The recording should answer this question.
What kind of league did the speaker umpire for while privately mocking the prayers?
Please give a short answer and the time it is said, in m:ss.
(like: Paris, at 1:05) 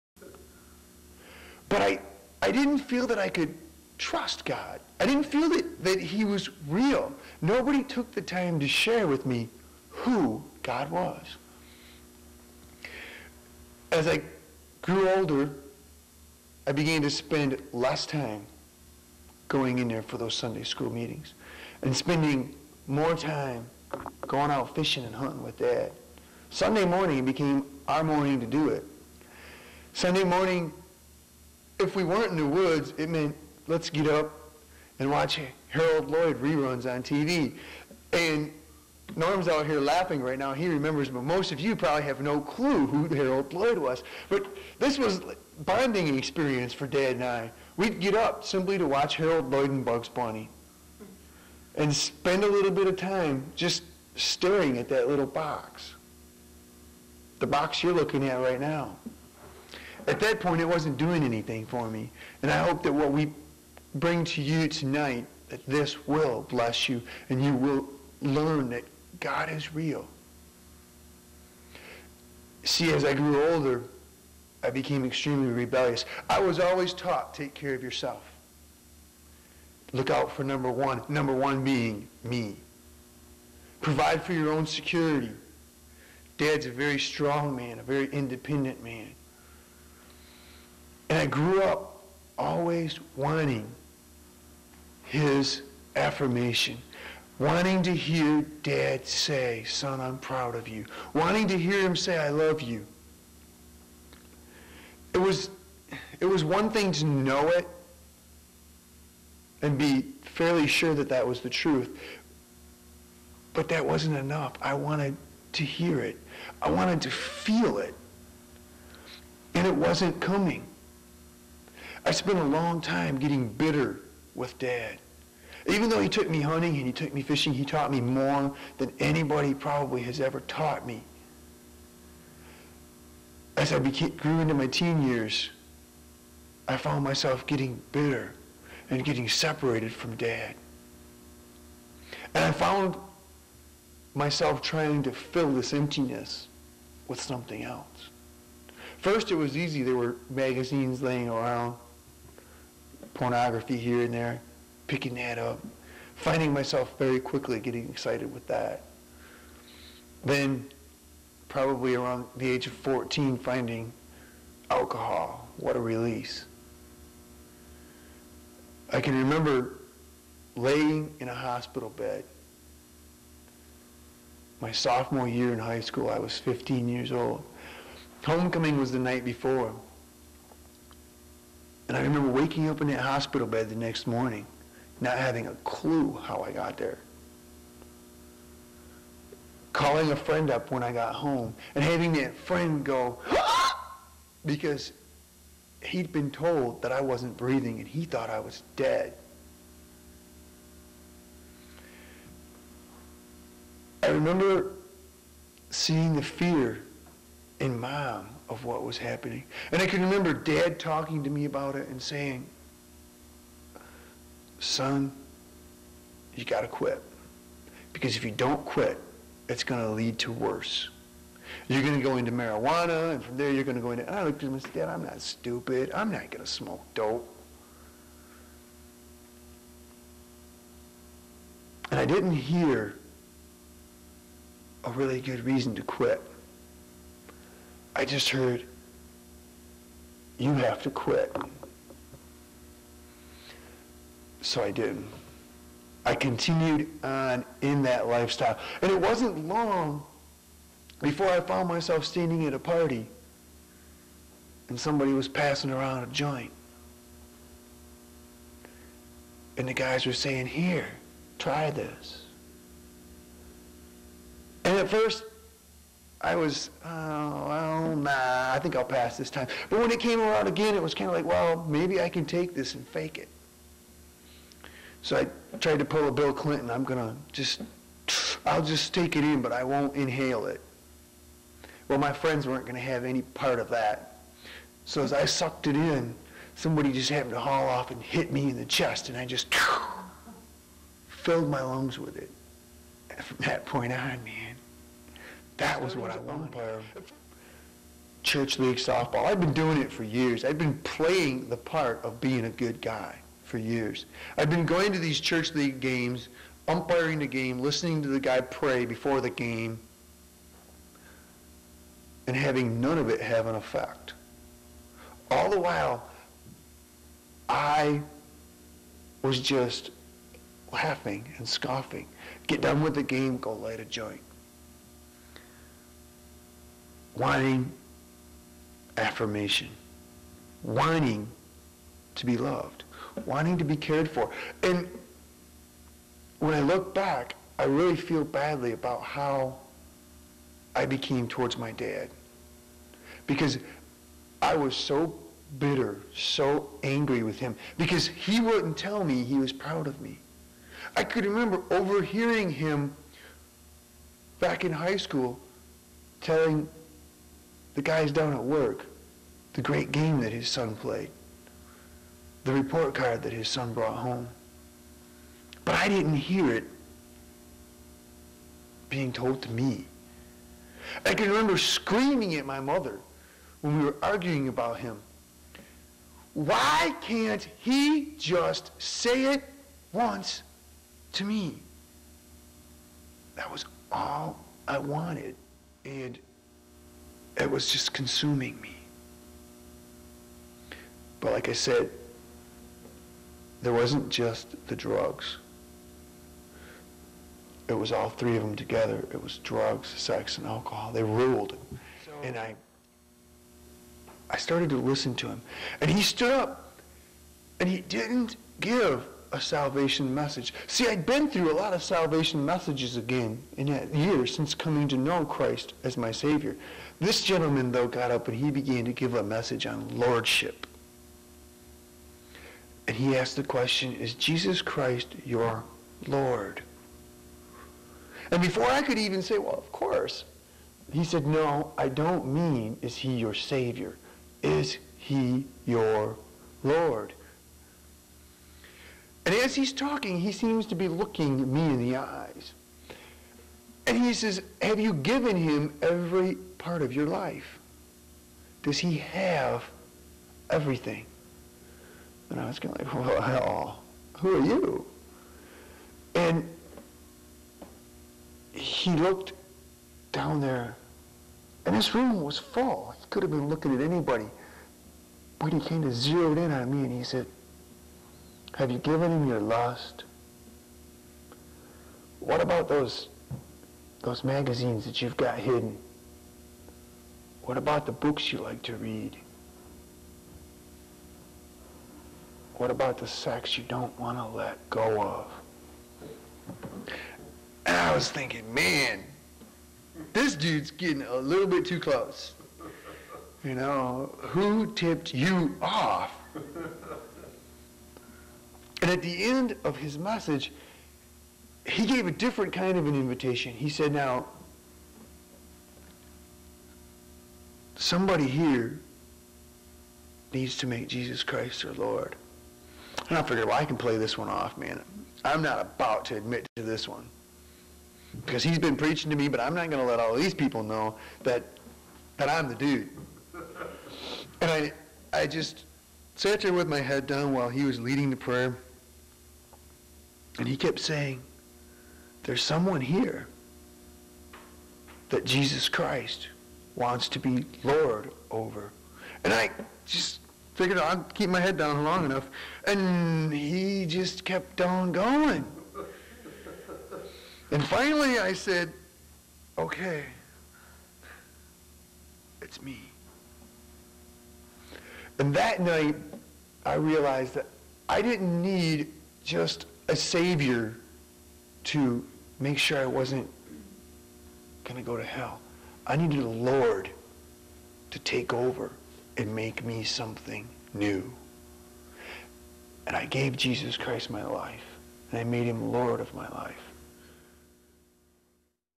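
Church league softball, at 4:58.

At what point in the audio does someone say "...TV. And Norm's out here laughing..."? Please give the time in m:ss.
0:37.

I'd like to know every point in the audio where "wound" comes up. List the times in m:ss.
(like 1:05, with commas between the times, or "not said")
not said.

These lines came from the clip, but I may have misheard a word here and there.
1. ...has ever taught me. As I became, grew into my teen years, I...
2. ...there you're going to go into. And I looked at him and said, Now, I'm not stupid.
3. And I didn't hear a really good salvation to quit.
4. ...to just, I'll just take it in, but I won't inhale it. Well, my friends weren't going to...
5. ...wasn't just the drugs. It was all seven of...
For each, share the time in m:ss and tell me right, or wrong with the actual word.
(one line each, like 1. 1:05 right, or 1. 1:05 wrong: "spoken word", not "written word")
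1. 2:10 right
2. 3:43 wrong: "Dad", not "Now"
3. 3:51 wrong: "reason", not "salvation"
4. 4:36 right
5. 6:33 wrong: "three", not "seven".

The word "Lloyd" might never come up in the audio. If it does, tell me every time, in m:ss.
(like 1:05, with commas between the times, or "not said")
0:36, 0:43, 0:49.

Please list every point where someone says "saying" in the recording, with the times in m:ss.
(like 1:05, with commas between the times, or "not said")
3:32, 4:20, 8:50.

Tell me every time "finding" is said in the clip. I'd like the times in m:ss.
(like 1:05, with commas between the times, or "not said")
2:36, 2:43.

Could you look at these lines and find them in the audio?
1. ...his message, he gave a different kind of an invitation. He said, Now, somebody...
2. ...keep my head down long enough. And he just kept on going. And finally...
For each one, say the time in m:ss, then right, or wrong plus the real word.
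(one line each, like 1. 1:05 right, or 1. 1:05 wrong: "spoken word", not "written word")
1. 8:19 right
2. 9:01 right.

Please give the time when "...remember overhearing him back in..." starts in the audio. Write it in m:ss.
5:51.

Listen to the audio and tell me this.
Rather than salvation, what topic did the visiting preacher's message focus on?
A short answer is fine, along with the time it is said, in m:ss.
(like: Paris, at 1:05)
Lordship, at 6:59.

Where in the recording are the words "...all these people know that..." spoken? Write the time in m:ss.
8:39.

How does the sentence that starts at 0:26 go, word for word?
Sunday morning became our morning to do it.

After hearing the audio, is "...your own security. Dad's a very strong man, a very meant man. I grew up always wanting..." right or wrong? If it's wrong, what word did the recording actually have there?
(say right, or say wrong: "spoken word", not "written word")
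wrong: "independent", not "meant".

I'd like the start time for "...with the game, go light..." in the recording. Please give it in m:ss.
5:22.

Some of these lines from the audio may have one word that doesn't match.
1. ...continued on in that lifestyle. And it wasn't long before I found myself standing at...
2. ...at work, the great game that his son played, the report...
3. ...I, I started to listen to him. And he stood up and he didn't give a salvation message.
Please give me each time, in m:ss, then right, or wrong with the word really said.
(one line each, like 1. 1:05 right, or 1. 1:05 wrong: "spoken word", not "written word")
1. 4:06 right
2. 5:58 right
3. 6:42 right.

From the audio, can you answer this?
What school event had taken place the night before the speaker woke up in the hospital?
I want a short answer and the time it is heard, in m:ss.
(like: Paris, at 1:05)
Homecoming, at 2:58.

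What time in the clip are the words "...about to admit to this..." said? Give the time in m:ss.
8:35.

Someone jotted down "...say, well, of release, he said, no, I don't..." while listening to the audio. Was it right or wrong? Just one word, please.
wrong.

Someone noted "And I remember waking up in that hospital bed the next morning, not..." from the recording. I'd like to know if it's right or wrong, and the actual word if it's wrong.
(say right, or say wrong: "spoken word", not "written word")
right.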